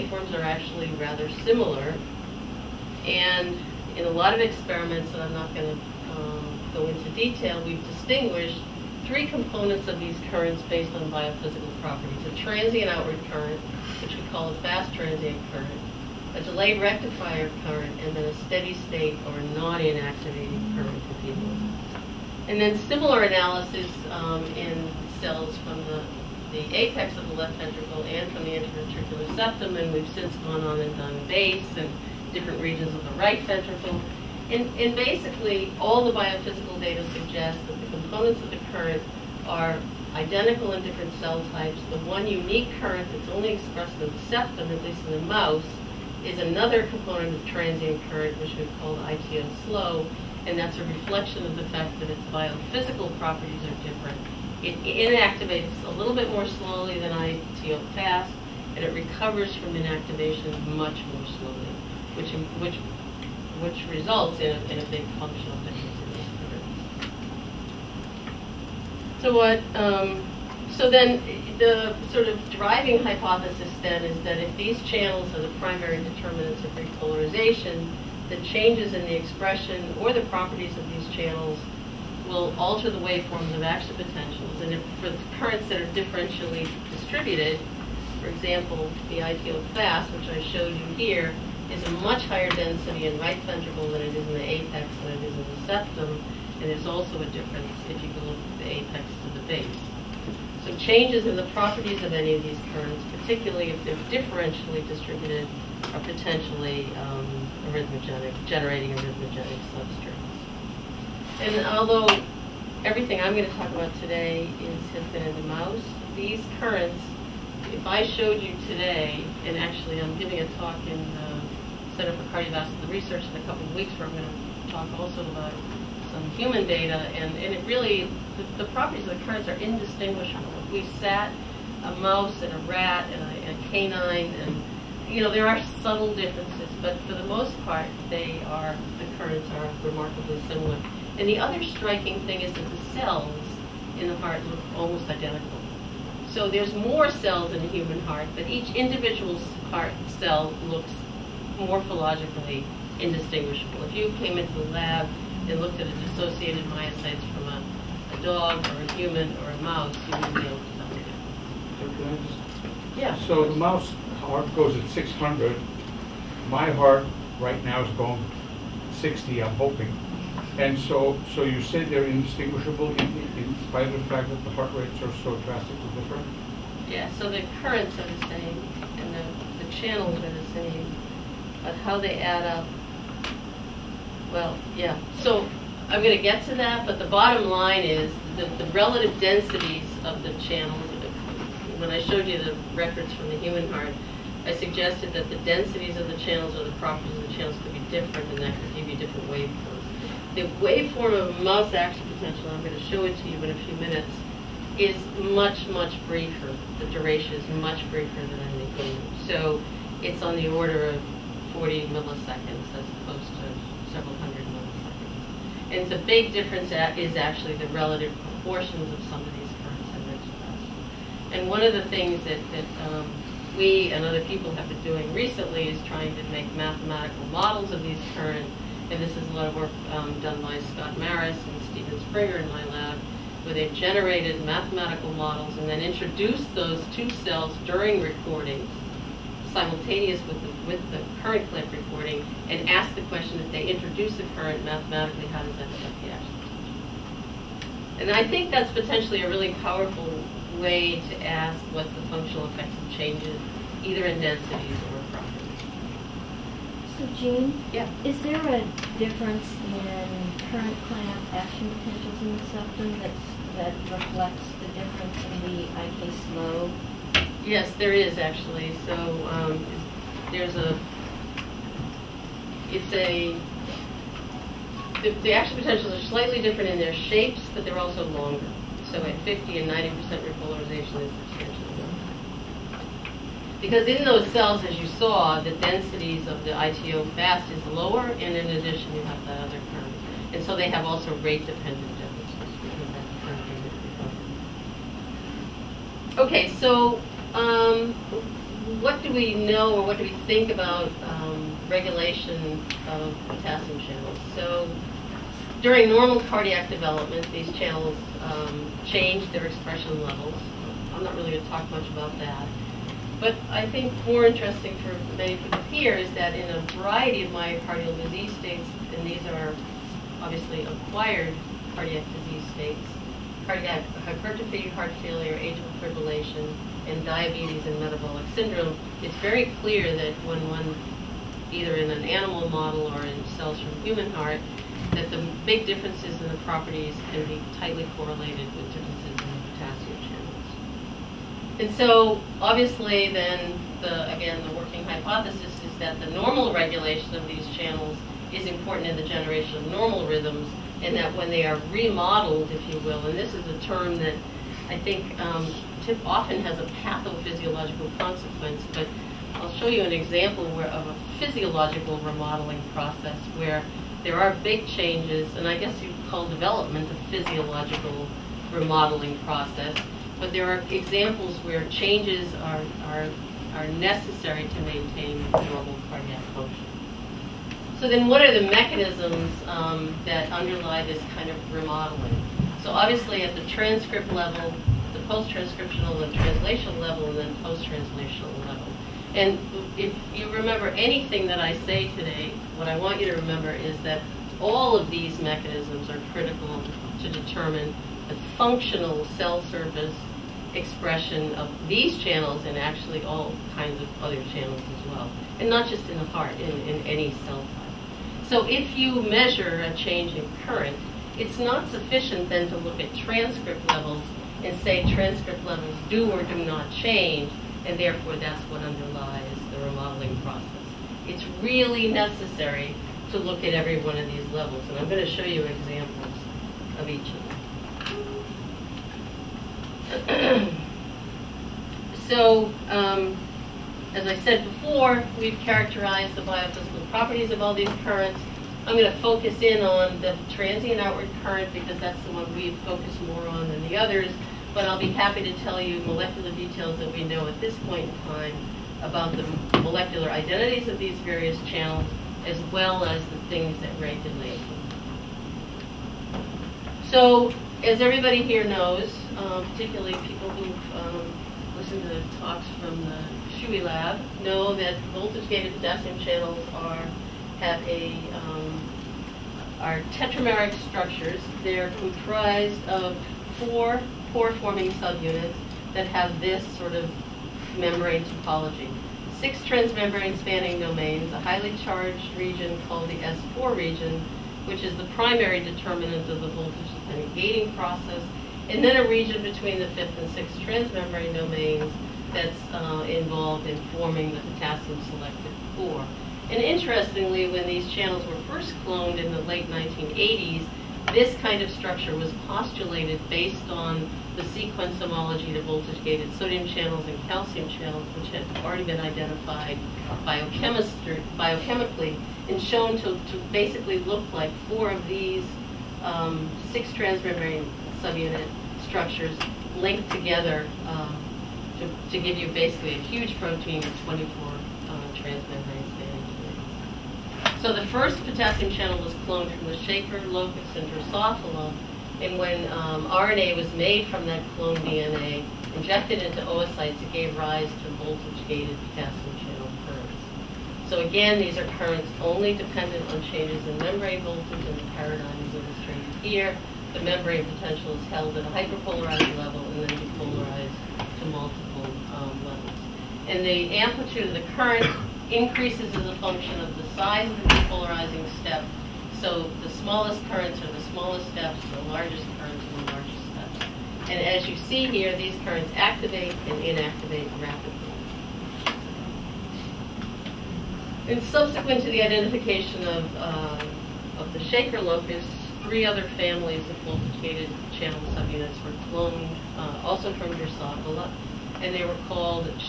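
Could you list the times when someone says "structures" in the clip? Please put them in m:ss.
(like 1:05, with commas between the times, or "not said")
7:50, 8:21, 8:38.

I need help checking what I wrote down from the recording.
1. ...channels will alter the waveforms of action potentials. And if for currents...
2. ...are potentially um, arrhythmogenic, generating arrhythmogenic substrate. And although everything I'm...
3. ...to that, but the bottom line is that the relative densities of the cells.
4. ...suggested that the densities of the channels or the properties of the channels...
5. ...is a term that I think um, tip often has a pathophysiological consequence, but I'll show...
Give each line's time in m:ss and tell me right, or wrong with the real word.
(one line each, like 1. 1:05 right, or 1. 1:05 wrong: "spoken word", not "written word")
1. 1:21 right
2. 1:45 right
3. 3:06 wrong: "channels", not "cells"
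4. 3:14 right
5. 5:53 right.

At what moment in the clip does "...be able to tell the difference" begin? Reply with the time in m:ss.
2:40.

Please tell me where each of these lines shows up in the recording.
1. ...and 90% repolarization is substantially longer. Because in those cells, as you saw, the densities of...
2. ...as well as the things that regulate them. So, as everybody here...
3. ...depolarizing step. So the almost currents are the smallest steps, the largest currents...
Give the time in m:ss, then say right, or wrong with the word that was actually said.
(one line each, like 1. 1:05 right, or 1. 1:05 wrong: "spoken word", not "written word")
1. 4:39 right
2. 7:32 right
3. 9:17 wrong: "smallest", not "almost".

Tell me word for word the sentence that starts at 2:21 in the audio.
And the other striking thing is that the cells in the heart look almost identical.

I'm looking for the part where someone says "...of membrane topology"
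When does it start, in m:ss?
7:56.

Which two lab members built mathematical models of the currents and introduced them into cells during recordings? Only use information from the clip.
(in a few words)
Scott Maris and Steven Springer.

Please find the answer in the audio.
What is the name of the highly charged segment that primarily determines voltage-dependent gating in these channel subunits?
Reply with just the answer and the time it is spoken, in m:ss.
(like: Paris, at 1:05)
S4 region, at 8:02.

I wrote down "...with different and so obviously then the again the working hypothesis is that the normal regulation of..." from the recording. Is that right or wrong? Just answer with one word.
right.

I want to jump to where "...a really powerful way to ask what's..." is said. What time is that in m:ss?
4:09.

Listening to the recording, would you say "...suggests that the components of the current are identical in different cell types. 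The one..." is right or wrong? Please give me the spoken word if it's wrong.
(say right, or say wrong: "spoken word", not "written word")
right.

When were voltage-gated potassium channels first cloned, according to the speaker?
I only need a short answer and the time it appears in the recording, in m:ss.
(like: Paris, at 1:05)
late 1980s, at 8:19.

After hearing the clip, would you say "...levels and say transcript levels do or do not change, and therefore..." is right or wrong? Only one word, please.
right.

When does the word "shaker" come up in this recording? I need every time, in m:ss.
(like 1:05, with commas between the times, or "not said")
8:49, 9:34.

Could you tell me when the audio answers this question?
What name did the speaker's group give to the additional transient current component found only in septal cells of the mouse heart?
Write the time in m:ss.
0:49.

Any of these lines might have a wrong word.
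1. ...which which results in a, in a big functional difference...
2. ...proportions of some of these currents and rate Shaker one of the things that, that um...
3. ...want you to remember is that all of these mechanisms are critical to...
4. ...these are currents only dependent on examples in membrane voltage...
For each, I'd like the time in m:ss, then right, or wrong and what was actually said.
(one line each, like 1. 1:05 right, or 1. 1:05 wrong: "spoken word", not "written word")
1. 1:02 right
2. 3:38 wrong: "And", not "Shaker"
3. 6:32 right
4. 9:01 wrong: "changes", not "examples".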